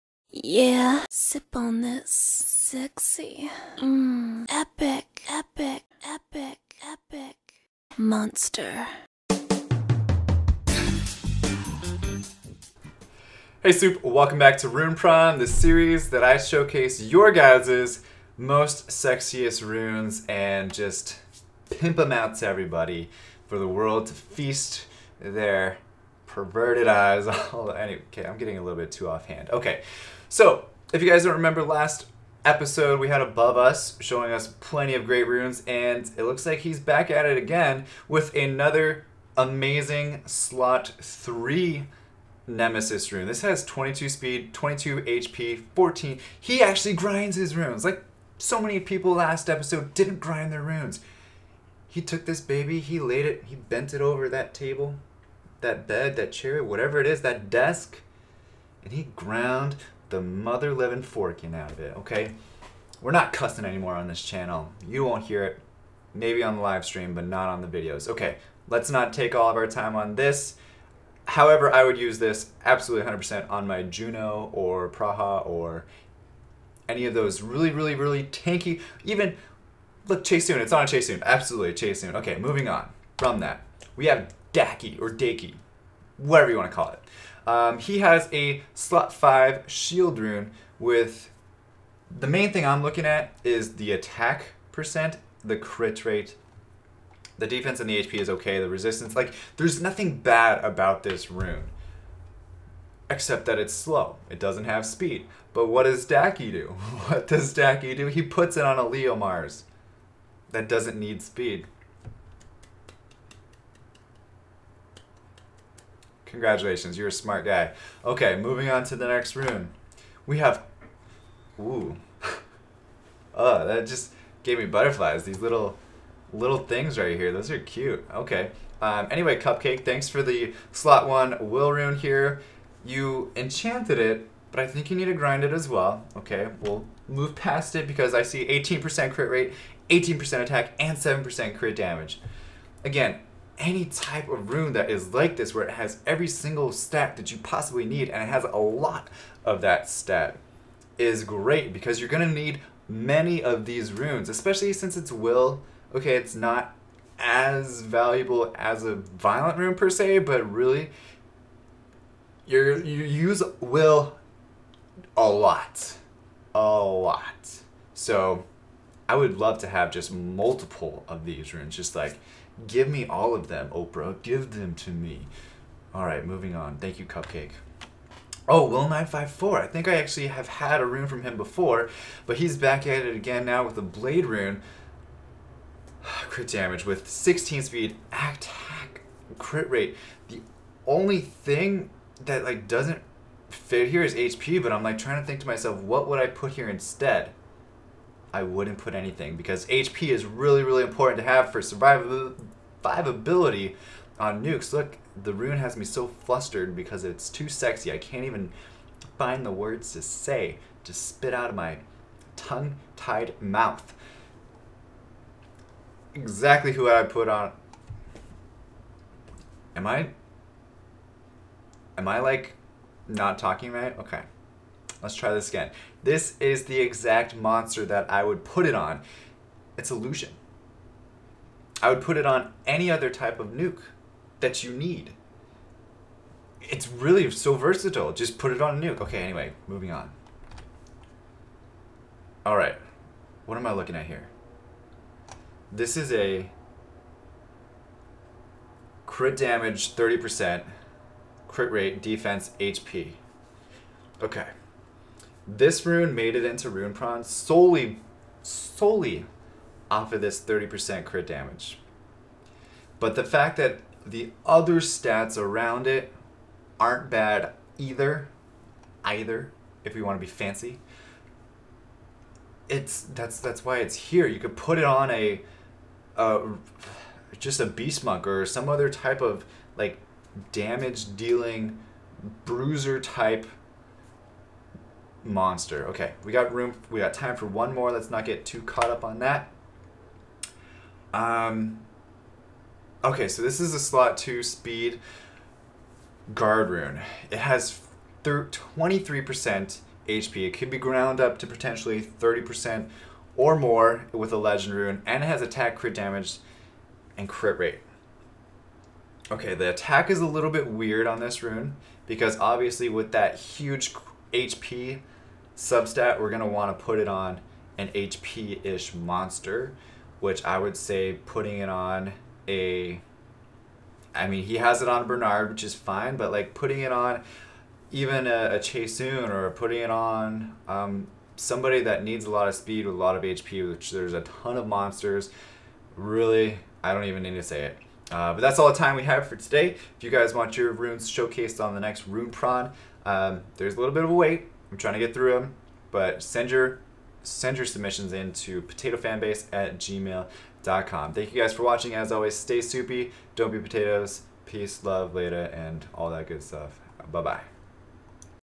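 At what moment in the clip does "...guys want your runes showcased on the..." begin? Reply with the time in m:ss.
5:40.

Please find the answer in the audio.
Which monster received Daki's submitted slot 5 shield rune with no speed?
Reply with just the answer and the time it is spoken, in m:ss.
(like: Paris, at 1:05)
Leo Mars, at 1:48.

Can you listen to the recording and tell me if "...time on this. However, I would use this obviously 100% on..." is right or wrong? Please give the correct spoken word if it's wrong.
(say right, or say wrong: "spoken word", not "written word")
wrong: "absolutely", not "obviously".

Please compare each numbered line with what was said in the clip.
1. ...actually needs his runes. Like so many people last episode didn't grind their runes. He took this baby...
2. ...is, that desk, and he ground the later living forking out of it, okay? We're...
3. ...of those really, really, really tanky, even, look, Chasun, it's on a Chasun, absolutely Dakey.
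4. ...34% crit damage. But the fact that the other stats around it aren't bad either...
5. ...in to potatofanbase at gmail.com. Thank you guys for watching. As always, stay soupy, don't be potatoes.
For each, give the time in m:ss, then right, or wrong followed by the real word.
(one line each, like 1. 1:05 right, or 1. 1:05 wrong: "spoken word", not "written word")
1. 0:46 wrong: "grinds", not "needs"
2. 0:57 wrong: "mother", not "later"
3. 1:17 wrong: "Chasun", not "Dakey"
4. 4:20 wrong: "30", not "34"
5. 5:48 right.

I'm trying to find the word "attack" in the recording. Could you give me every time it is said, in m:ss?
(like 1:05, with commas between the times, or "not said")
1:33, 2:20, 3:08, 5:05, 5:09.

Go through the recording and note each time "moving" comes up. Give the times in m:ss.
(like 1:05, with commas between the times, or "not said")
1:22, 1:58, 2:56, 3:59.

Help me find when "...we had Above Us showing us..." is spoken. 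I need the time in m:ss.
0:32.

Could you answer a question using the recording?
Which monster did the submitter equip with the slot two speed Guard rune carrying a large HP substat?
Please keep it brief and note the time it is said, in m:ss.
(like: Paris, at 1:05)
Bernard, at 5:25.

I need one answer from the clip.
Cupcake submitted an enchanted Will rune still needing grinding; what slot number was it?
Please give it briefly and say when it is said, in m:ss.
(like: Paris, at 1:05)
1, at 2:10.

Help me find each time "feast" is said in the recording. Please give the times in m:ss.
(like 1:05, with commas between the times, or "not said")
0:24.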